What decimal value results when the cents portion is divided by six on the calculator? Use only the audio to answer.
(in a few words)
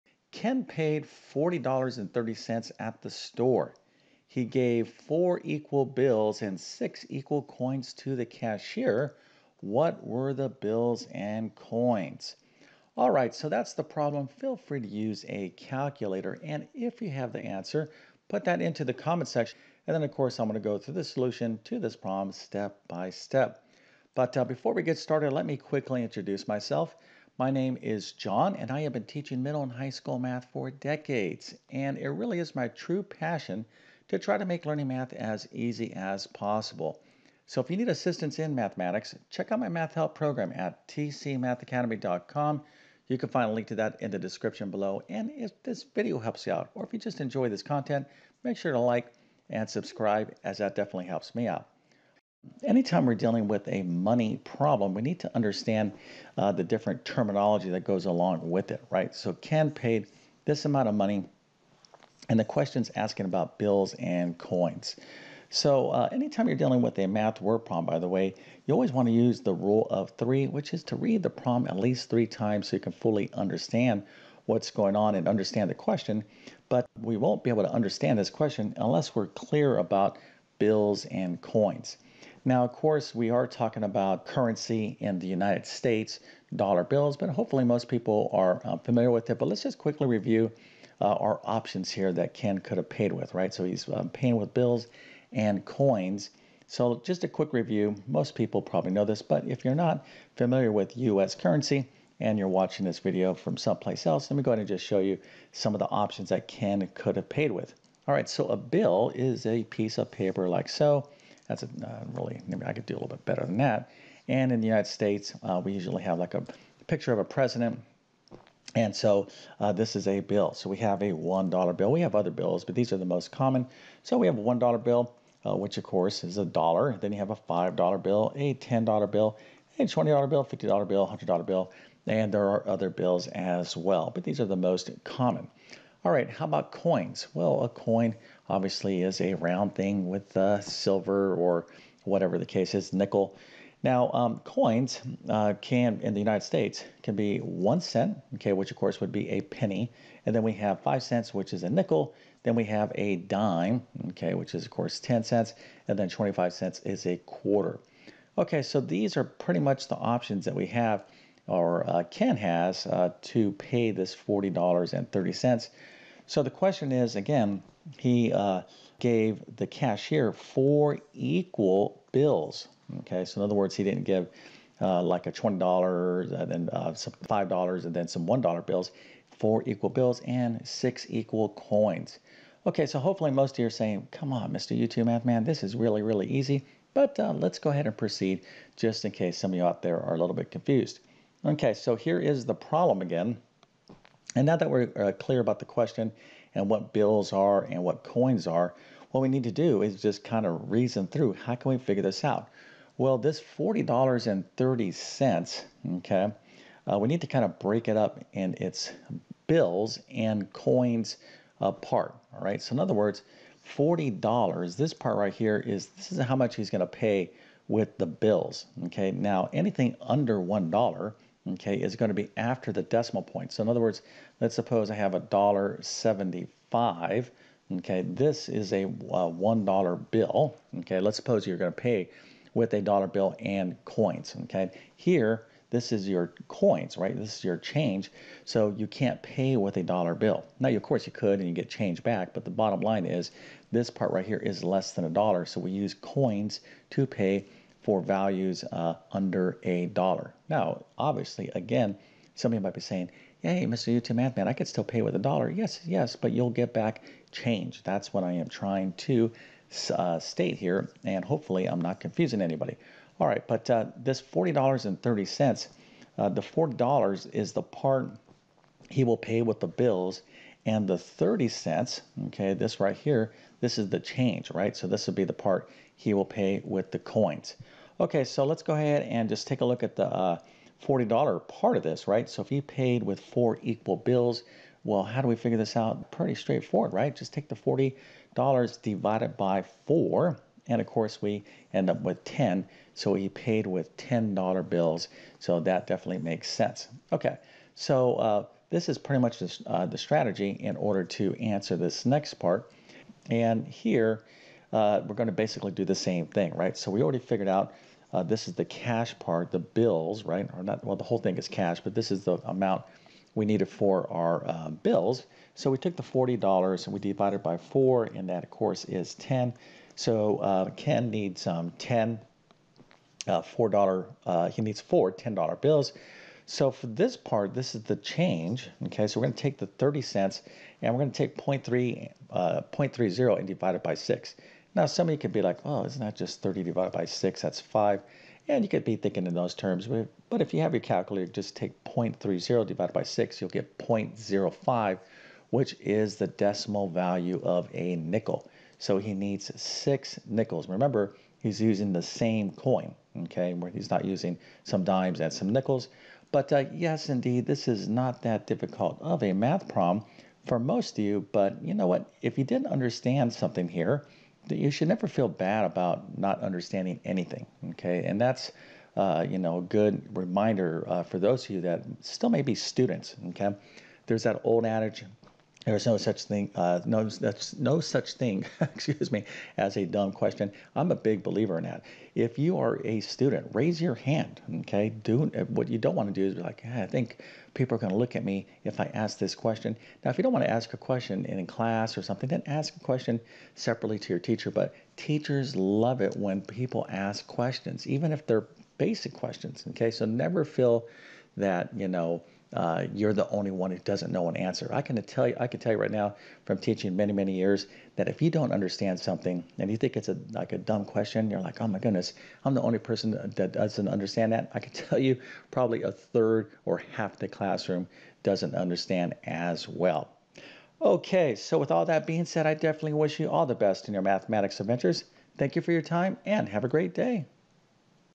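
0.05.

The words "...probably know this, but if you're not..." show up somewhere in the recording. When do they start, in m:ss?
1:38.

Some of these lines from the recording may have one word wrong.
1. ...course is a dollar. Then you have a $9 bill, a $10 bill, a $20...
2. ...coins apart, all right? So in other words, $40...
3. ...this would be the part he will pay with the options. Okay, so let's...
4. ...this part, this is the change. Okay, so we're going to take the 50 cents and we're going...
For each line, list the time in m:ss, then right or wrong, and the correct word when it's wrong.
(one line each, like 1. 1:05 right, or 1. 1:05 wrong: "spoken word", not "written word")
1. 2:05 wrong: "5", not "9"
2. 3:30 right
3. 4:34 wrong: "coins", not "options"
4. 5:26 wrong: "30", not "50".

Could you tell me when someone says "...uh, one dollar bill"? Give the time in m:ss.
3:48.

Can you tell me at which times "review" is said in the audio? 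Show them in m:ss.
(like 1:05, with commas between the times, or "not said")
1:30, 1:37.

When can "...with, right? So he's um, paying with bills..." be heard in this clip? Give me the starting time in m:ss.
1:33.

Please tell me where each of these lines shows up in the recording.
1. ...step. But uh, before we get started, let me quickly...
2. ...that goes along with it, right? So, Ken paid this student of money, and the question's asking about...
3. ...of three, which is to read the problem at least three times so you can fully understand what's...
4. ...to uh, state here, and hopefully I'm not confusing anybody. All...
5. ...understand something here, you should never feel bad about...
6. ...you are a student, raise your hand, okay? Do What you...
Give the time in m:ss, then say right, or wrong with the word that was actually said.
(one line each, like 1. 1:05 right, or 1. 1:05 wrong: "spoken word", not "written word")
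1. 0:23 right
2. 0:57 wrong: "amount", not "student"
3. 1:09 right
4. 4:18 right
5. 6:02 right
6. 6:22 right.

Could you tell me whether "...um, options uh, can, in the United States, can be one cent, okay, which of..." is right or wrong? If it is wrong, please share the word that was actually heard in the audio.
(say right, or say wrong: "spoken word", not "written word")
wrong: "coins", not "options".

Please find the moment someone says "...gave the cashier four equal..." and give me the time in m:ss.
2:48.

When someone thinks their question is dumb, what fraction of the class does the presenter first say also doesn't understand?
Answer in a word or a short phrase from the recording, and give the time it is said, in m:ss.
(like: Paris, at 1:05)
a third, at 6:55.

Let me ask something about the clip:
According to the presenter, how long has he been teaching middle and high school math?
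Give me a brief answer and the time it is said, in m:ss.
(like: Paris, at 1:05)
decades, at 0:30.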